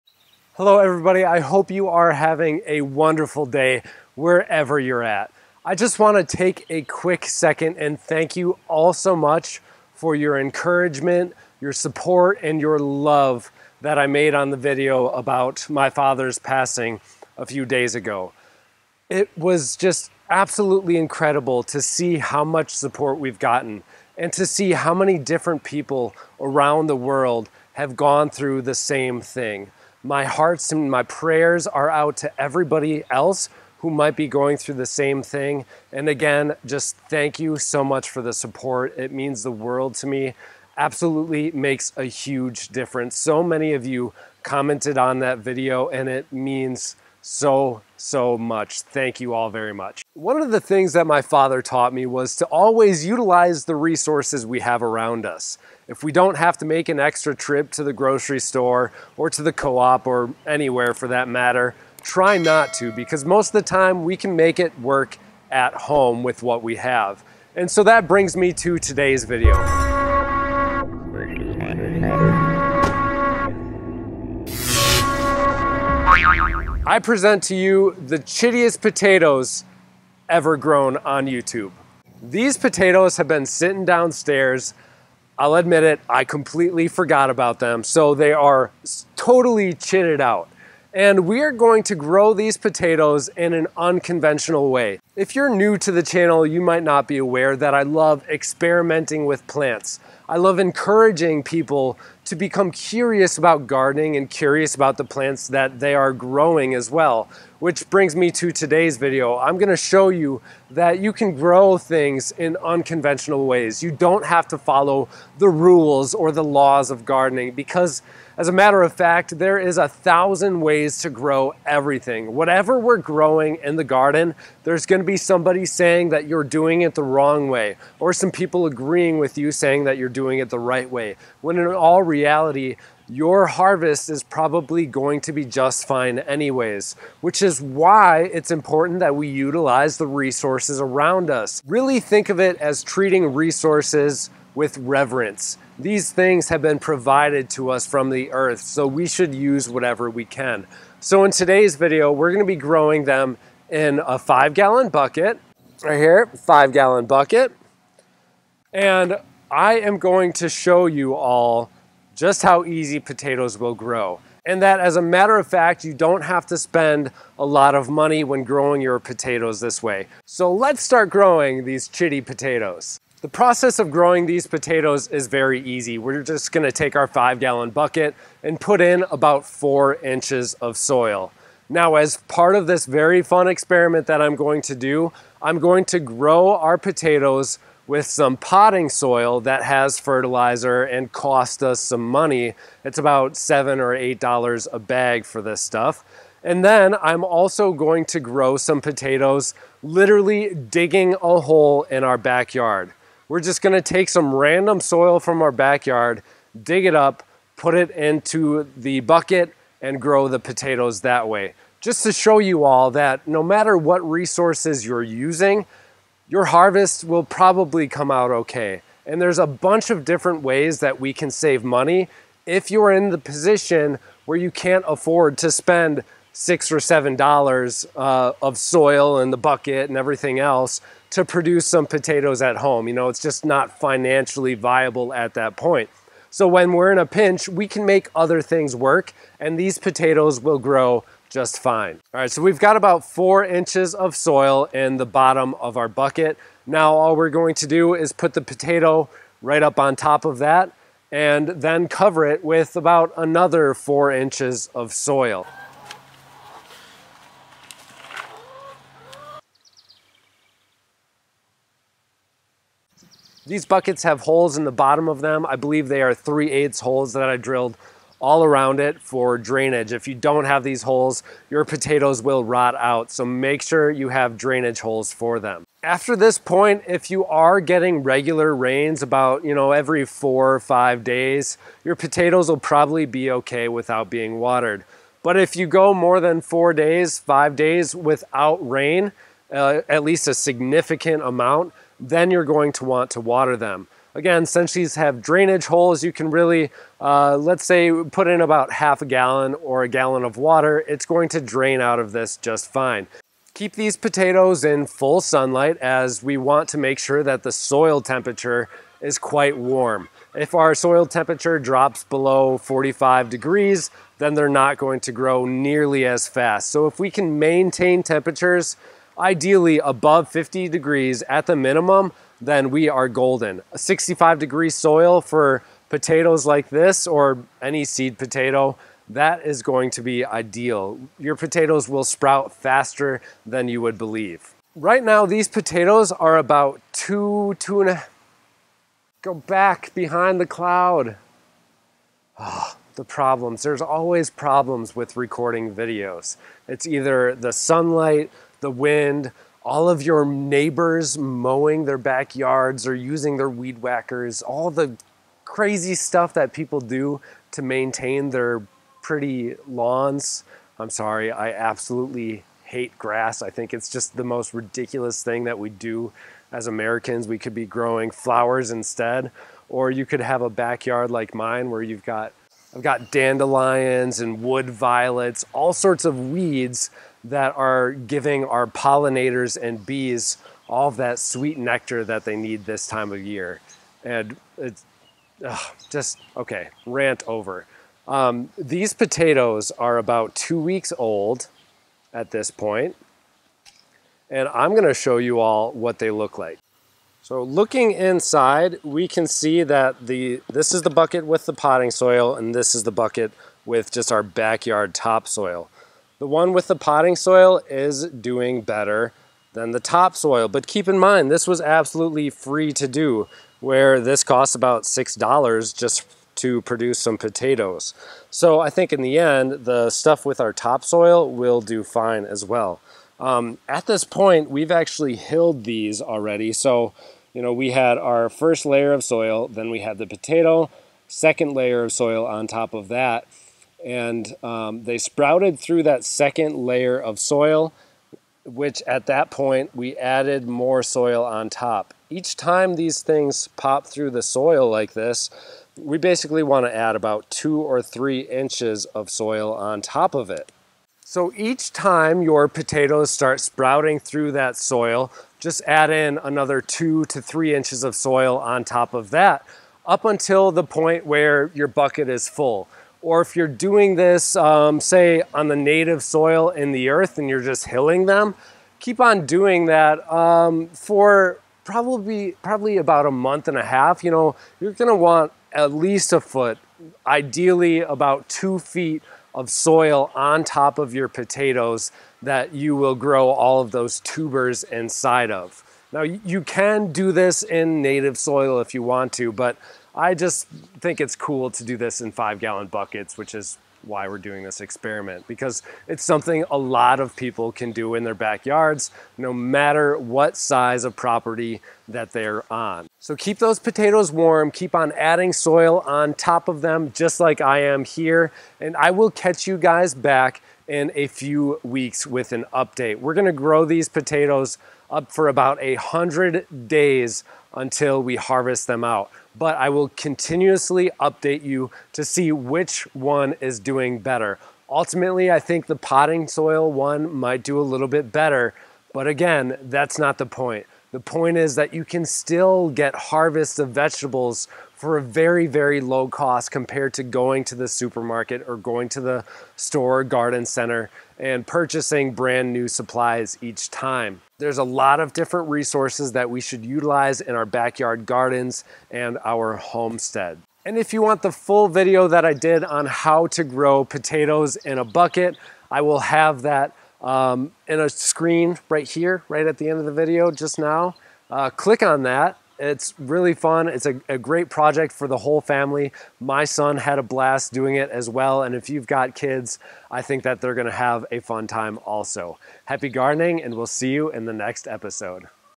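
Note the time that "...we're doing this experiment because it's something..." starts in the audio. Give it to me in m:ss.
8:14.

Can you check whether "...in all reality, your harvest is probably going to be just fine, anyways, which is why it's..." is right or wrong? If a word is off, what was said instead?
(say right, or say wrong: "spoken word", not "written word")
right.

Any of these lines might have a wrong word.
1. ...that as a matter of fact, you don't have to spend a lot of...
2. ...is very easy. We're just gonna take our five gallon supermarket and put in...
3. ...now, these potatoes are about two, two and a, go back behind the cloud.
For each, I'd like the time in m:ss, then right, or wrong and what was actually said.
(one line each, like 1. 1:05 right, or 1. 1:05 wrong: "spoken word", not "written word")
1. 2:44 right
2. 2:55 wrong: "bucket", not "supermarket"
3. 5:35 right.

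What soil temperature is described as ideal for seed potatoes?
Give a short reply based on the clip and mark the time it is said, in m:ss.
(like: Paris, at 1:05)
65 degrees, at 5:23.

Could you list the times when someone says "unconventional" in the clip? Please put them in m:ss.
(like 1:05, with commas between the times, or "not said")
1:33, 1:52.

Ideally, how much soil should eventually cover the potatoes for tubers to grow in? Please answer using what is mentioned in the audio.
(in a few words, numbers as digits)
2 feet.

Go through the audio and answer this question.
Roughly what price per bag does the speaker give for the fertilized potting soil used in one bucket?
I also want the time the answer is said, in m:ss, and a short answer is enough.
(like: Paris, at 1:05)
$7 or $8, at 3:13.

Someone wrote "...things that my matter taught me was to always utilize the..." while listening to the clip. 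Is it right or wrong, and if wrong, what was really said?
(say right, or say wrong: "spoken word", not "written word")
wrong: "father", not "matter".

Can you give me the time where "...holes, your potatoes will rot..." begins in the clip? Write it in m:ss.
4:30.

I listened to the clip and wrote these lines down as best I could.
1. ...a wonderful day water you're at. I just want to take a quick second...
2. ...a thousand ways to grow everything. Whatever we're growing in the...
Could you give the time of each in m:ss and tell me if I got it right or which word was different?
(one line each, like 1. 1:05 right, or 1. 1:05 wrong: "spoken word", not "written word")
1. 0:02 wrong: "wherever", not "water"
2. 1:59 right.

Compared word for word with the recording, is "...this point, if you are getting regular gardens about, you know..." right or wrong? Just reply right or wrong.
wrong.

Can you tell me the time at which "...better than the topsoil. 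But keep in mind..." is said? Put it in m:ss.
6:48.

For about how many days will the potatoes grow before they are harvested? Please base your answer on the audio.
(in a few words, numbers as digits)
100 days.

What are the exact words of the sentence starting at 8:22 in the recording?
So keep those potatoes warm, keep on adding soil on top of them, just like I am here.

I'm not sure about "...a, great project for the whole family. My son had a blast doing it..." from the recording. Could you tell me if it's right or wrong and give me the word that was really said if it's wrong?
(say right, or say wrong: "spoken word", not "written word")
right.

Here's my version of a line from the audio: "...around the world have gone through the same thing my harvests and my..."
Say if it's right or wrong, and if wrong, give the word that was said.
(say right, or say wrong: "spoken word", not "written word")
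wrong: "hearts", not "harvests".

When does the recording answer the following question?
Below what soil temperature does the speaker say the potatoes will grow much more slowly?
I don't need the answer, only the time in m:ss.
5:12.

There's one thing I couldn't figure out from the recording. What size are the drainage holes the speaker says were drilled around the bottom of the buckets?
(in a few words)
3/8.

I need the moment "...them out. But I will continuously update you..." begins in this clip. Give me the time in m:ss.
8:38.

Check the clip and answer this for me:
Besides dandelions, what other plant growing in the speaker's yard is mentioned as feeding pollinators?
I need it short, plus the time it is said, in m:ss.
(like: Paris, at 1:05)
wood violets, at 6:14.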